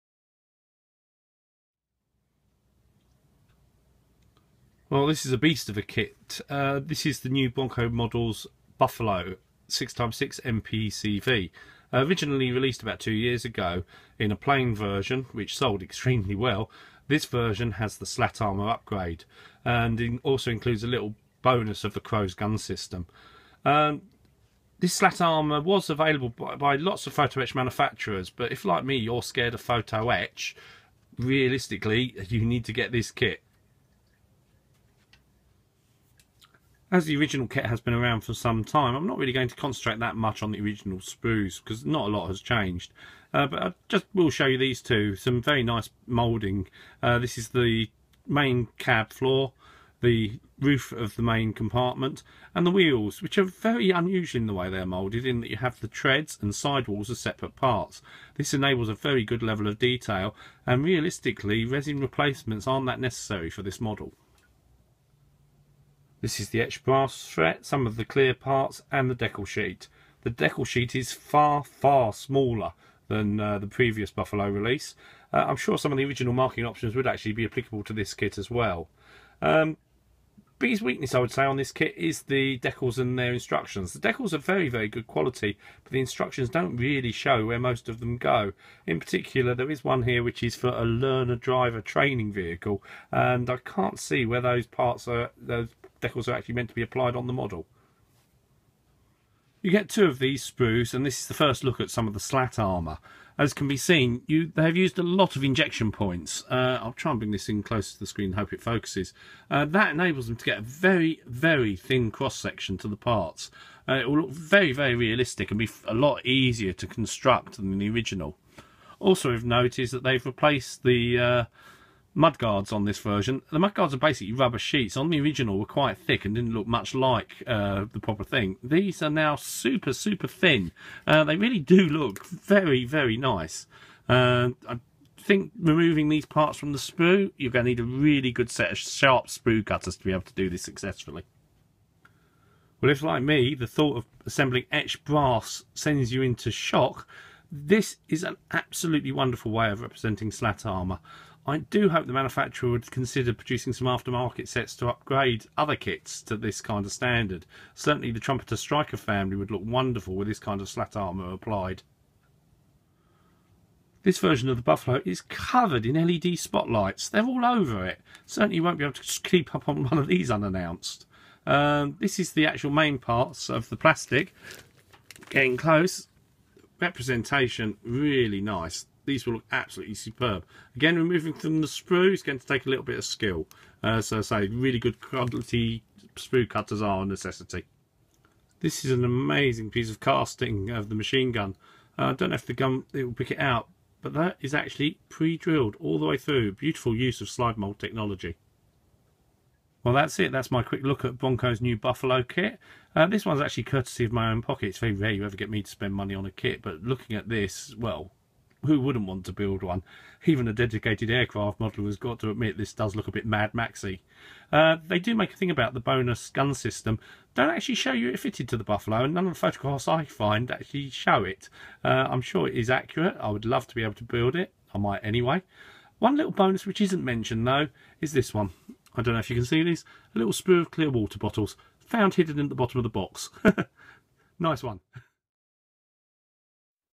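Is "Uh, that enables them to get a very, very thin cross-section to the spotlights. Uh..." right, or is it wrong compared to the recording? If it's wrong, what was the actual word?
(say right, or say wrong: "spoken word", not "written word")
wrong: "parts", not "spotlights".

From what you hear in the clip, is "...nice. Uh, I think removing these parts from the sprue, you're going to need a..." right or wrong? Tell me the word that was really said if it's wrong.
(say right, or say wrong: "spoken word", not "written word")
right.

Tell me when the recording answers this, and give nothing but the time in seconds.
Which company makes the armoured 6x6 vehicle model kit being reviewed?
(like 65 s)
7 s.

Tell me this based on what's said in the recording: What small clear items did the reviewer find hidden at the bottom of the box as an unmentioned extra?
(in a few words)
Water bottles.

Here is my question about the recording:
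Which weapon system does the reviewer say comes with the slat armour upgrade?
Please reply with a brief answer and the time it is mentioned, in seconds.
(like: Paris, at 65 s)
CROWS, at 22 s.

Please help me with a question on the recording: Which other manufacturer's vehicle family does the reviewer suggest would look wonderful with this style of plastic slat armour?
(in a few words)
Trumpeter Striker.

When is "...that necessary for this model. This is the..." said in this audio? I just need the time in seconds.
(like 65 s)
62 s.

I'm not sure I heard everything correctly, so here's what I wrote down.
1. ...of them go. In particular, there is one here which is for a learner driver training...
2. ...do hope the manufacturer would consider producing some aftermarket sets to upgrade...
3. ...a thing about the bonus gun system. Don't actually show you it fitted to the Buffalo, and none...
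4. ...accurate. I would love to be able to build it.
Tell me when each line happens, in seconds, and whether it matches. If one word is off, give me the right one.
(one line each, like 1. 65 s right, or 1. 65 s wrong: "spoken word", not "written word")
1. 87 s right
2. 151 s right
3. 215 s right
4. 222 s right.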